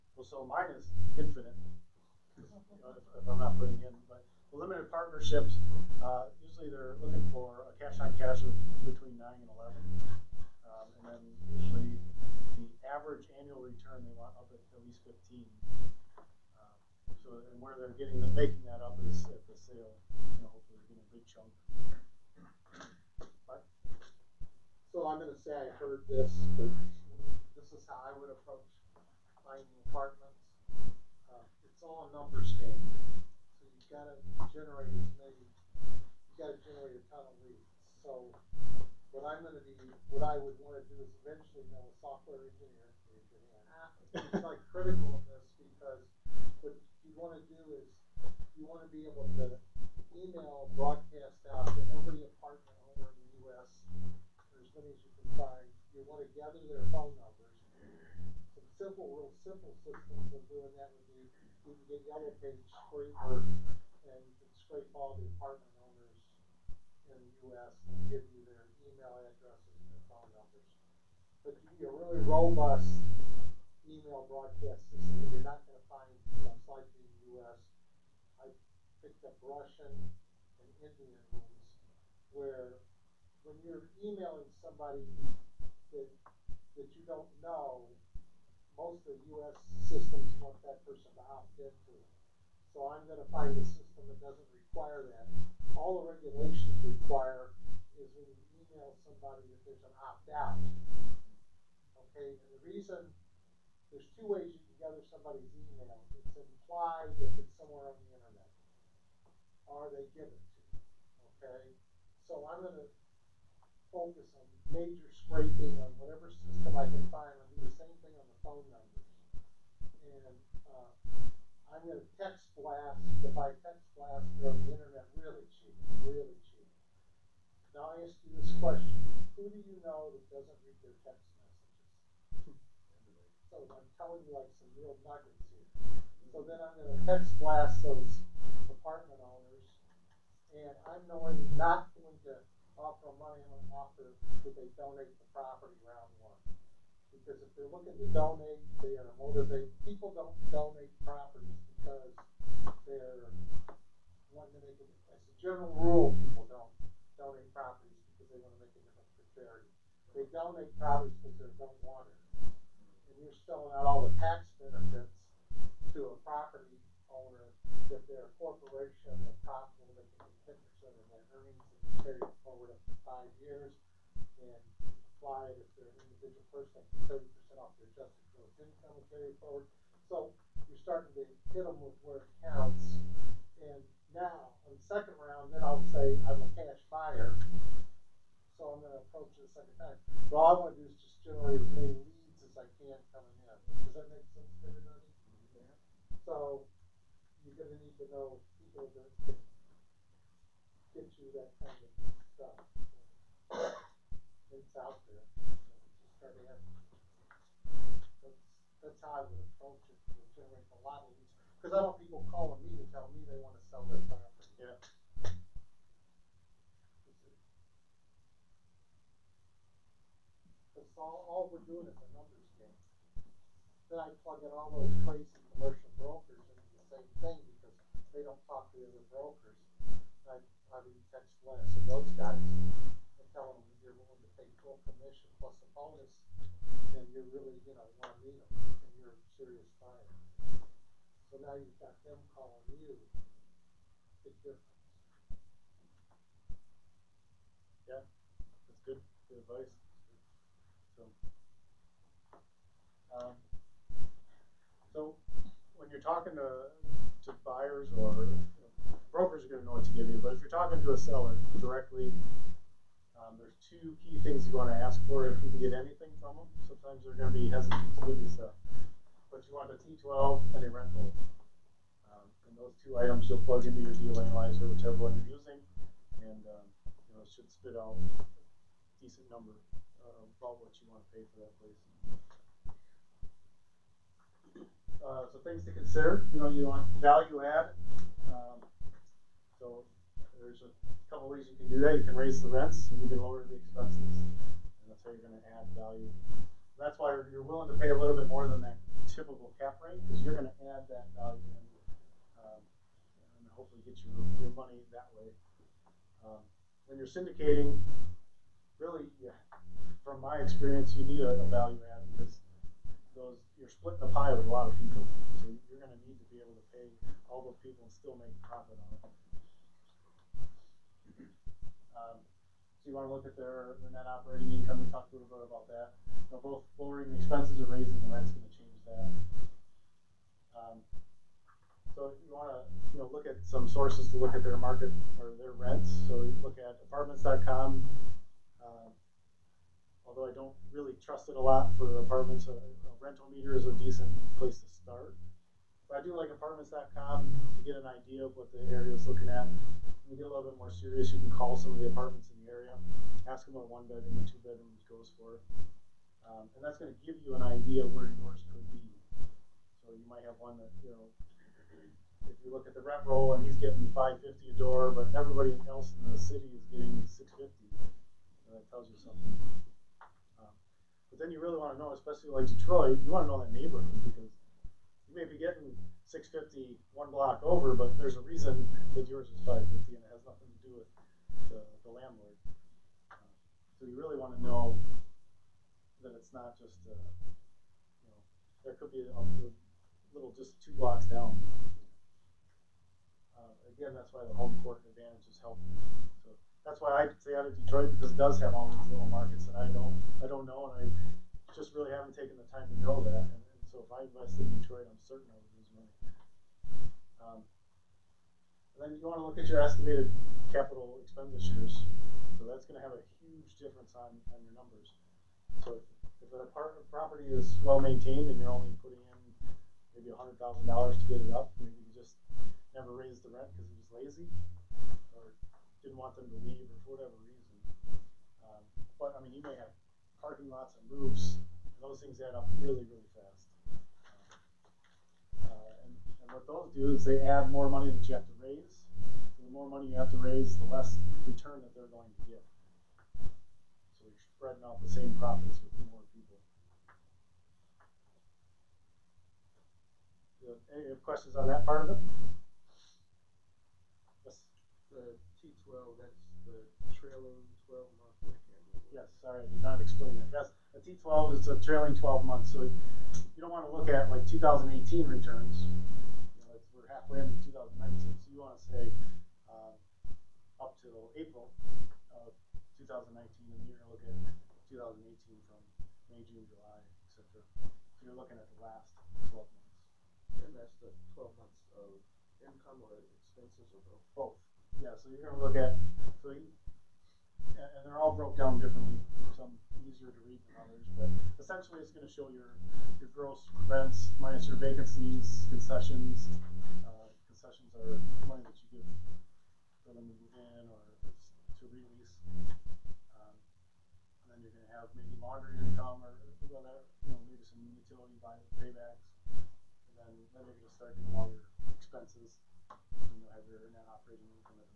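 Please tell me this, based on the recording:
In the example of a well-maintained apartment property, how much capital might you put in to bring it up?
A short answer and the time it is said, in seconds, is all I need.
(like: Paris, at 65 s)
$100,000, at 420 s.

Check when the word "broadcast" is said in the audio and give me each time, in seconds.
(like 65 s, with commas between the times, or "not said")
50 s, 74 s.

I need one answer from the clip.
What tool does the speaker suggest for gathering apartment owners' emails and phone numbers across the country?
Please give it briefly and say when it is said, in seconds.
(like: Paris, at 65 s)
Yellow Page Scraper, at 62 s.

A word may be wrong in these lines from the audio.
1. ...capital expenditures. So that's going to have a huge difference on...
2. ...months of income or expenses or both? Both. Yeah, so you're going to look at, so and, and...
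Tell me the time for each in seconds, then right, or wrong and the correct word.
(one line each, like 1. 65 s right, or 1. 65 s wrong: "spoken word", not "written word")
1. 410 s right
2. 481 s right.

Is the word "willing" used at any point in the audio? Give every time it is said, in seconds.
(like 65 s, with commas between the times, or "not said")
233 s, 297 s.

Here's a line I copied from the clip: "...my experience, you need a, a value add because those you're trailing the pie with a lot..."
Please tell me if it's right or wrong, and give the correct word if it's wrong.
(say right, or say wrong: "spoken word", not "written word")
wrong: "splitting", not "trailing".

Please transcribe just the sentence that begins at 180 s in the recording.
So you're starting to hit them with where it counts.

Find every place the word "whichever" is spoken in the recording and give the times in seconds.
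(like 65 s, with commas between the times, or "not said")
274 s.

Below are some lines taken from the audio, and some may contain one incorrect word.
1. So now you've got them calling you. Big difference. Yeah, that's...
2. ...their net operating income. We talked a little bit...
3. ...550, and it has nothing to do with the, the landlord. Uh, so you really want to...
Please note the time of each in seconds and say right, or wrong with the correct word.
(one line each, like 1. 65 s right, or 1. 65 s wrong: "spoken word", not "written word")
1. 241 s right
2. 323 s right
3. 379 s right.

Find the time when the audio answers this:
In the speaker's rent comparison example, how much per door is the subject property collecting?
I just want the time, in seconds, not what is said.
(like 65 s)
363 s.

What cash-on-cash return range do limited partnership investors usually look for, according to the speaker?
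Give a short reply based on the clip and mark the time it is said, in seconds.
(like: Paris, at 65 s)
9 to 11, at 8 s.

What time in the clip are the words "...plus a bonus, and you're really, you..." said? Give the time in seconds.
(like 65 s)
235 s.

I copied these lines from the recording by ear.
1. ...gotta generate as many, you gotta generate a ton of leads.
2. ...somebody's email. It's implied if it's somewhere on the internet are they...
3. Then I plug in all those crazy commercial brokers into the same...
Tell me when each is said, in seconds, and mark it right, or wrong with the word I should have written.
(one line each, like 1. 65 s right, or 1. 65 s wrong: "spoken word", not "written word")
1. 33 s right
2. 105 s right
3. 223 s right.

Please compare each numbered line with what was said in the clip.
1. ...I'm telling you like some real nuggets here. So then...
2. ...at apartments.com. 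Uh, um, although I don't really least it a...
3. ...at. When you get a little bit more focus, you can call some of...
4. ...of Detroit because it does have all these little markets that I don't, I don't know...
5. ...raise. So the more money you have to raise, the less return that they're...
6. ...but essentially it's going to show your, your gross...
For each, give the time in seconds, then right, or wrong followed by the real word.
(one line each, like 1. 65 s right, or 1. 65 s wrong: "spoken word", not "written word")
1. 133 s right
2. 336 s wrong: "trust", not "least"
3. 349 s wrong: "serious", not "focus"
4. 397 s right
5. 438 s right
6. 490 s right.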